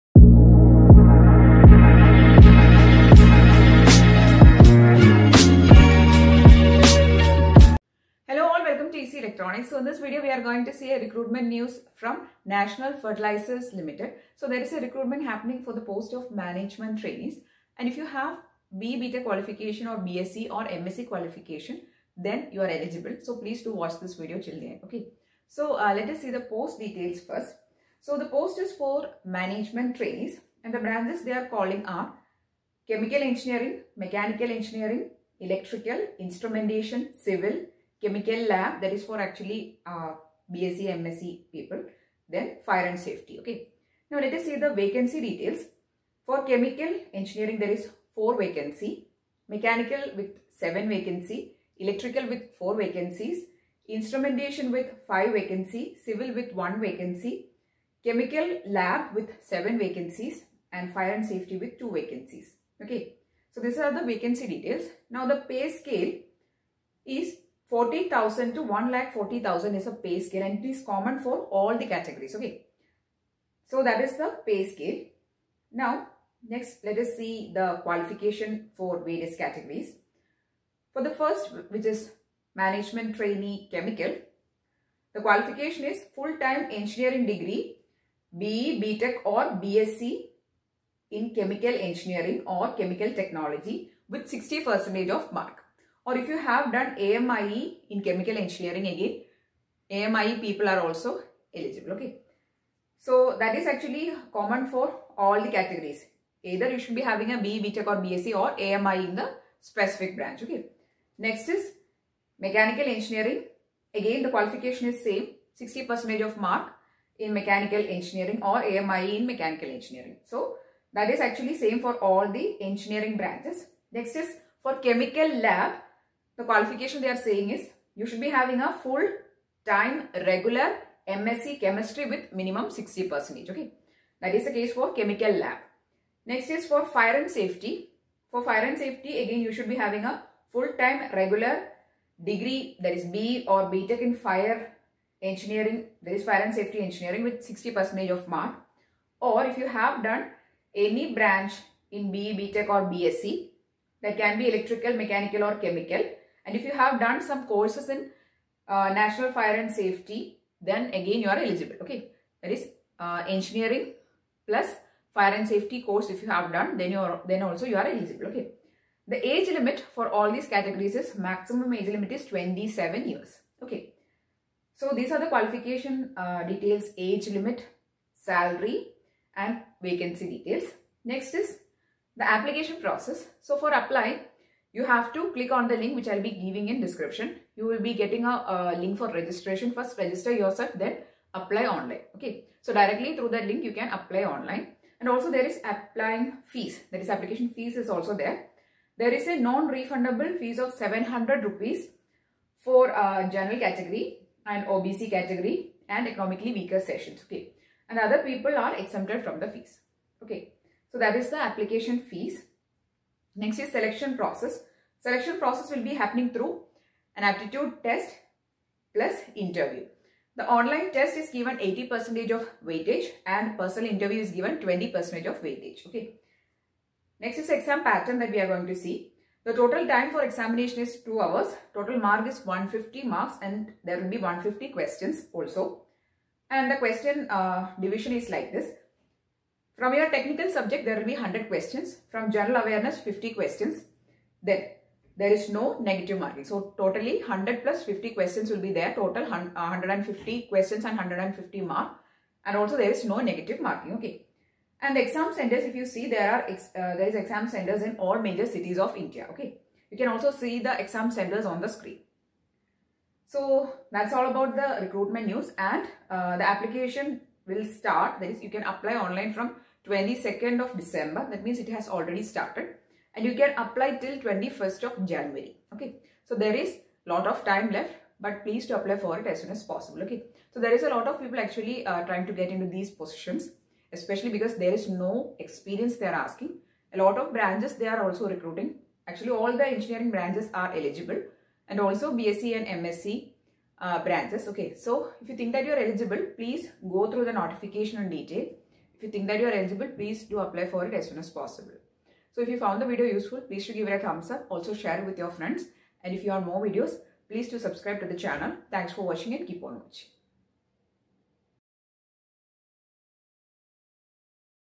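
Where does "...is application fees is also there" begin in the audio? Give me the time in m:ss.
3:17.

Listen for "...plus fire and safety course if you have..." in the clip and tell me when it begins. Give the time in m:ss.
2:44.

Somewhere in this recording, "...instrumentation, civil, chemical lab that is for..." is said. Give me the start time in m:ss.
0:36.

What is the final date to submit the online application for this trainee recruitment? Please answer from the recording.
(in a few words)
21st of January.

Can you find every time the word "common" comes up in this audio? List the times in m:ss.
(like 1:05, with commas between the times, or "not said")
1:10, 1:44.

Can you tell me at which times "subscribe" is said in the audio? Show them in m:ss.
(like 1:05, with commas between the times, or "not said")
5:07.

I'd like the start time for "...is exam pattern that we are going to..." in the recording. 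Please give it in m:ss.
3:47.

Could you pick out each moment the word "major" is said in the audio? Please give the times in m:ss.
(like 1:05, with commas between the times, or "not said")
4:18.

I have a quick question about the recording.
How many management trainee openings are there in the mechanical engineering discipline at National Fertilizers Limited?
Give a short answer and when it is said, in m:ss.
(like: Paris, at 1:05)
7, at 0:49.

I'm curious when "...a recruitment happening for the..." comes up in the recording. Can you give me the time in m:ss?
0:14.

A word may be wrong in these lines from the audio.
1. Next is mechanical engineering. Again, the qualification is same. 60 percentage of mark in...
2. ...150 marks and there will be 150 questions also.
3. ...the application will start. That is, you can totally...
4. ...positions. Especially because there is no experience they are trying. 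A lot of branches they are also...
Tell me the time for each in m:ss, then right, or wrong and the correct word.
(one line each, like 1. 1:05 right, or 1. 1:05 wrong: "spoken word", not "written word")
1. 1:51 right
2. 3:52 right
3. 4:26 wrong: "apply", not "totally"
4. 4:42 wrong: "asking", not "trying".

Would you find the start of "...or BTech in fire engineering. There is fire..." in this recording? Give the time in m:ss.
2:23.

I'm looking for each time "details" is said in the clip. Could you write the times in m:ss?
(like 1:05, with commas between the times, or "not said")
0:26, 0:45, 1:04, 2:56, 3:00, 4:58.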